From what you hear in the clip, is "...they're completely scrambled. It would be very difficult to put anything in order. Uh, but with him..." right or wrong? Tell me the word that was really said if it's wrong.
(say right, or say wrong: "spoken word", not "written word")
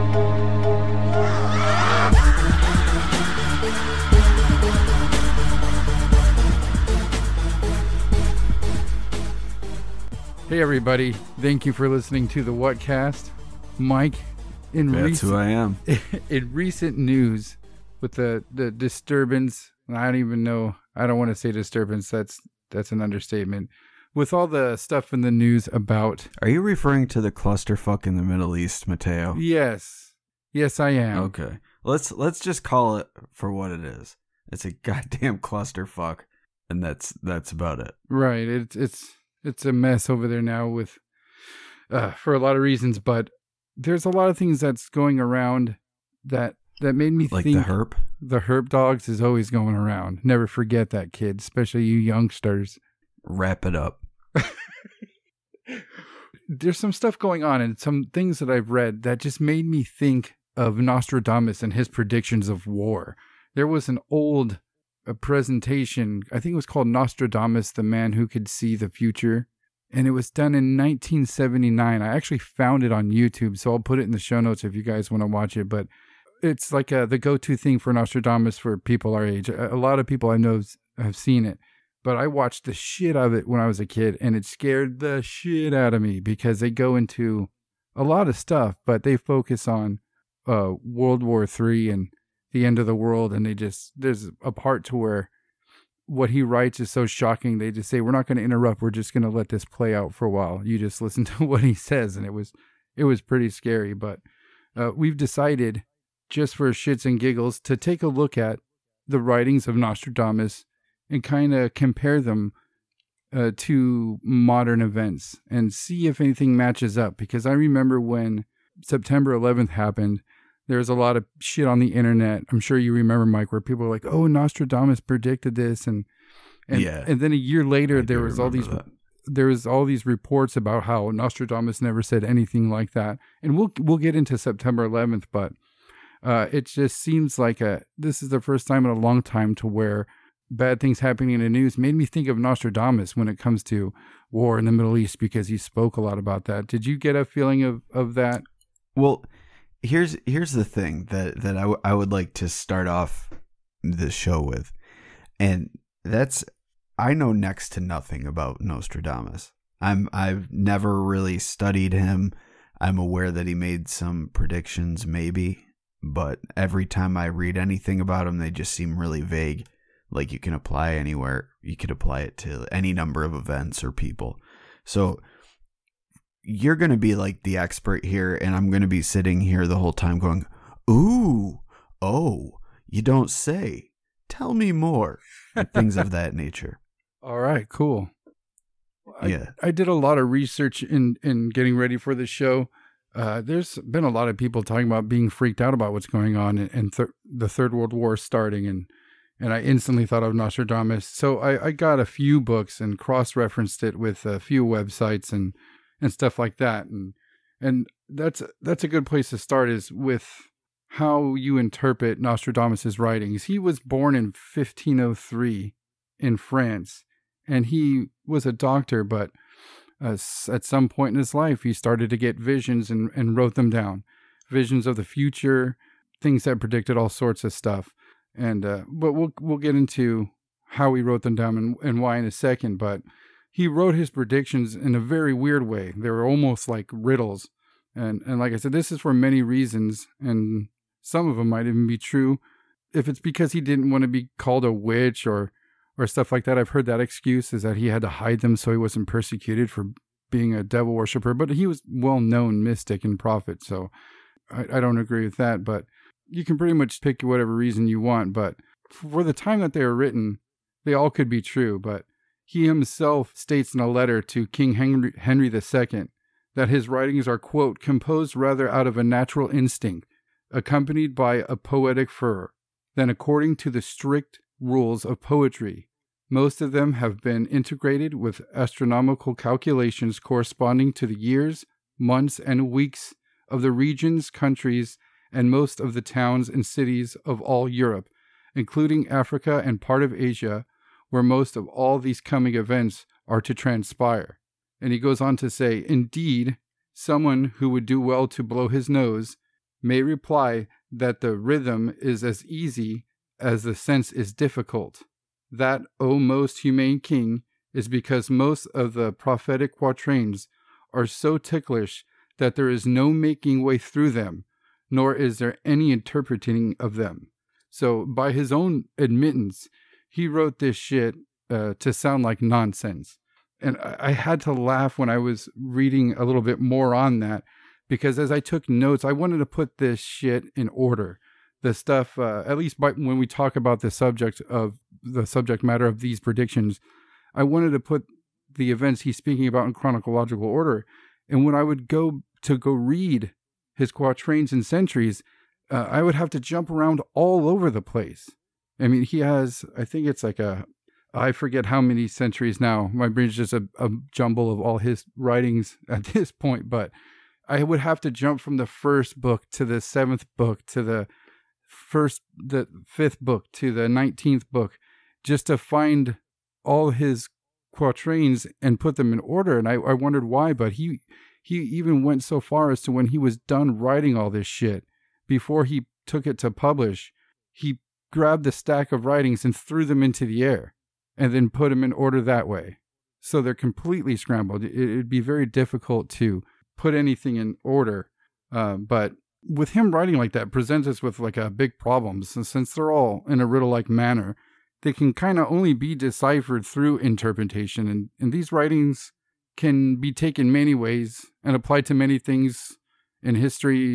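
right.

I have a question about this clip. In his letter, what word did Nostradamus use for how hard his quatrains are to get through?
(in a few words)
ticklish.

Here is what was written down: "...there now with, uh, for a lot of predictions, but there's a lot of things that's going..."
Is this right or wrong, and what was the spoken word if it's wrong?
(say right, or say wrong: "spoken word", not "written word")
wrong: "reasons", not "predictions".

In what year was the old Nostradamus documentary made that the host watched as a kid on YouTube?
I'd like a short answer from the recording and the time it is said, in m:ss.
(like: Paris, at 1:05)
1979, at 1:10.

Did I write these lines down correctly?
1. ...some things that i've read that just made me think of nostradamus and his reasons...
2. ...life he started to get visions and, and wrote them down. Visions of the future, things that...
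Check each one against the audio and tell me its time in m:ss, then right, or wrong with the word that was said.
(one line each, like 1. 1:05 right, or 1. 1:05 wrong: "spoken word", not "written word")
1. 0:57 wrong: "predictions", not "reasons"
2. 3:41 right.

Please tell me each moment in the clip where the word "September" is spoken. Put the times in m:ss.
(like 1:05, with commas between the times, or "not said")
1:58, 2:14.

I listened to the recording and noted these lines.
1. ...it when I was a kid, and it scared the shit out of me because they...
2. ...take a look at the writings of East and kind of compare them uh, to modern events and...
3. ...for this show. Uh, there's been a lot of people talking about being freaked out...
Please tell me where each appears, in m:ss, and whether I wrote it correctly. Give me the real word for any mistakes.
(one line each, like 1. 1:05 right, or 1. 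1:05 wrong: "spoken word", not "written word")
1. 1:23 right
2. 1:47 wrong: "Nostradamus", not "East"
3. 3:11 right.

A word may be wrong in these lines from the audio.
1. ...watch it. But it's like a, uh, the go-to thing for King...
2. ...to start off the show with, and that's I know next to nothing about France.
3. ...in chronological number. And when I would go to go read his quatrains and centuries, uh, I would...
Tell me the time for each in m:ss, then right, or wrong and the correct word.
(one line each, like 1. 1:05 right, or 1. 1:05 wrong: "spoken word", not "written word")
1. 1:15 wrong: "Nostradamus", not "King"
2. 2:32 wrong: "Nostradamus", not "France"
3. 5:39 wrong: "order", not "number".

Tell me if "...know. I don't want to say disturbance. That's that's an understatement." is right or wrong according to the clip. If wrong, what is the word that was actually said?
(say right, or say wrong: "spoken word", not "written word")
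right.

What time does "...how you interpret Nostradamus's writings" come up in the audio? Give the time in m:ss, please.
3:30.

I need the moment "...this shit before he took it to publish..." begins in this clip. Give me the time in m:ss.
6:14.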